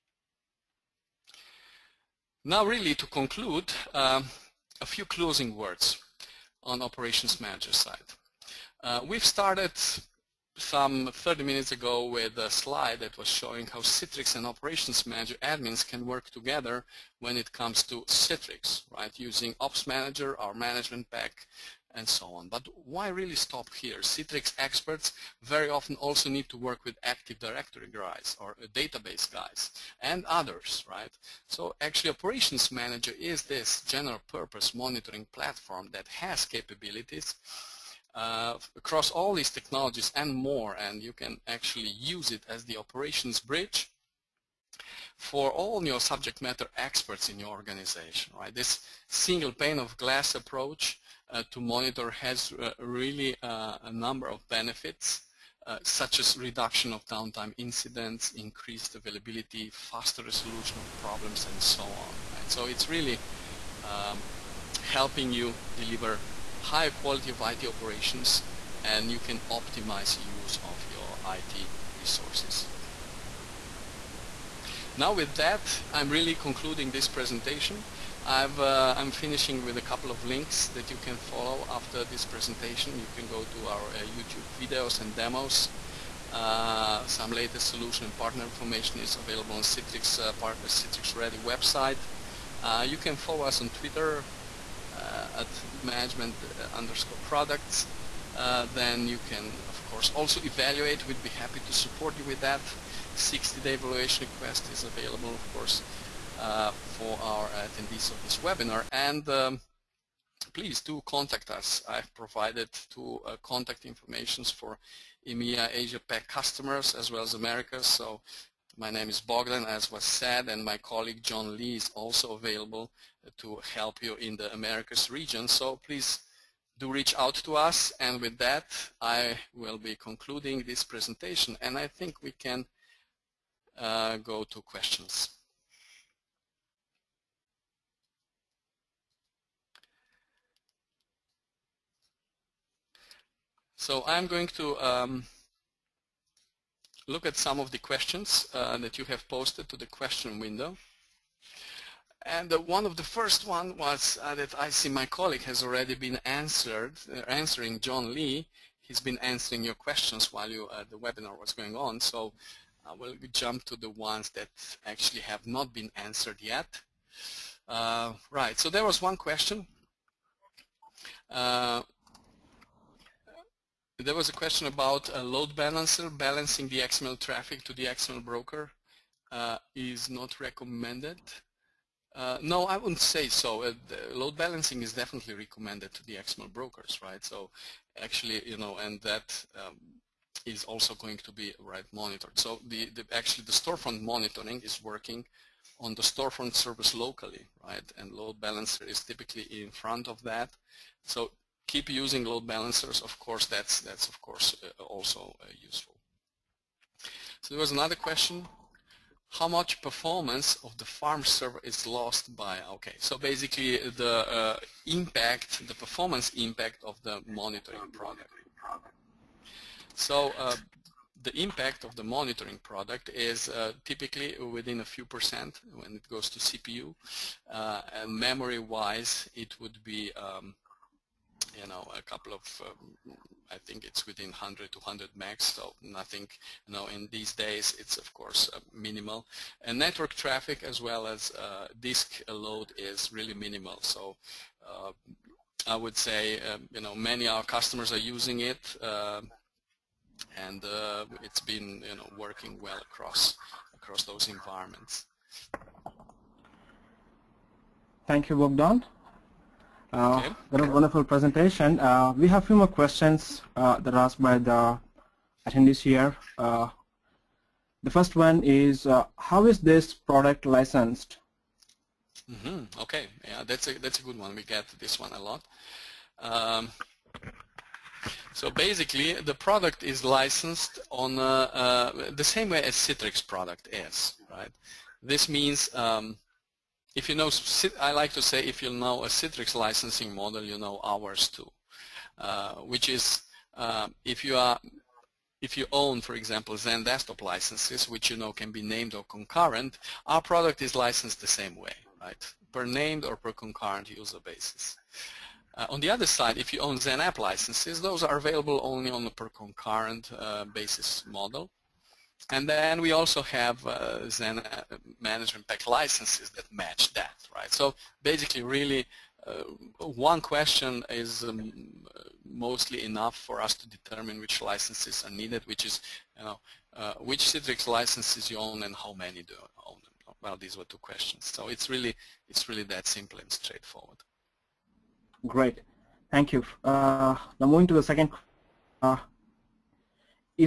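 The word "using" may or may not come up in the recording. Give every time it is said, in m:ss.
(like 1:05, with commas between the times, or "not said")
0:19, 3:21, 4:08.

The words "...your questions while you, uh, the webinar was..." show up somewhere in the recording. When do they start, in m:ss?
2:39.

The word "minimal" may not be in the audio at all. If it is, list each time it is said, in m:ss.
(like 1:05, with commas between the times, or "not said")
3:58, 4:03.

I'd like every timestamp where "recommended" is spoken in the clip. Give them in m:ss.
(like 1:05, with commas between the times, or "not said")
3:00, 3:05.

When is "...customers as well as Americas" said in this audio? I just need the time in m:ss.
1:56.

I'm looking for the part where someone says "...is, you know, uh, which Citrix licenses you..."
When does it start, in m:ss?
5:25.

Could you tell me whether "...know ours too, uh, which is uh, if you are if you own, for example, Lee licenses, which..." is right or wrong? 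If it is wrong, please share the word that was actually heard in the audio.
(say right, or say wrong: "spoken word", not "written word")
wrong: "XenDesktop", not "Lee".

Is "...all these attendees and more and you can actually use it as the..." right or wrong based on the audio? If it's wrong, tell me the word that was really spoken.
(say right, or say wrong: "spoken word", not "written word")
wrong: "technologies", not "attendees".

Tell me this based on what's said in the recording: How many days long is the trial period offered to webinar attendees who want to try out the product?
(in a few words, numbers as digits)
60.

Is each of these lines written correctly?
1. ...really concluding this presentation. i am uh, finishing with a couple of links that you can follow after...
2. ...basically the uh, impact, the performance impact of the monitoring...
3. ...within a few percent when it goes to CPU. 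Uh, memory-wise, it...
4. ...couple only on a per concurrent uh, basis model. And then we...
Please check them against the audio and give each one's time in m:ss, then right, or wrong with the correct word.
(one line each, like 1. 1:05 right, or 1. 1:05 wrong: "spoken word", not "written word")
1. 1:16 right
2. 3:33 right
3. 3:44 right
4. 5:08 wrong: "available", not "couple".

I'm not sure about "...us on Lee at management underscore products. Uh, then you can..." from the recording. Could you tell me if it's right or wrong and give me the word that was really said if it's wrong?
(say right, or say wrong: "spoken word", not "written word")
wrong: "Twitter", not "Lee".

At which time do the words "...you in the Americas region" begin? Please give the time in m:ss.
2:04.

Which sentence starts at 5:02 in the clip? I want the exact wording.
Per named or per concurrent user basis.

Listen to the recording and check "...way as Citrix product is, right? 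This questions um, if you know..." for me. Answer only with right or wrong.
wrong.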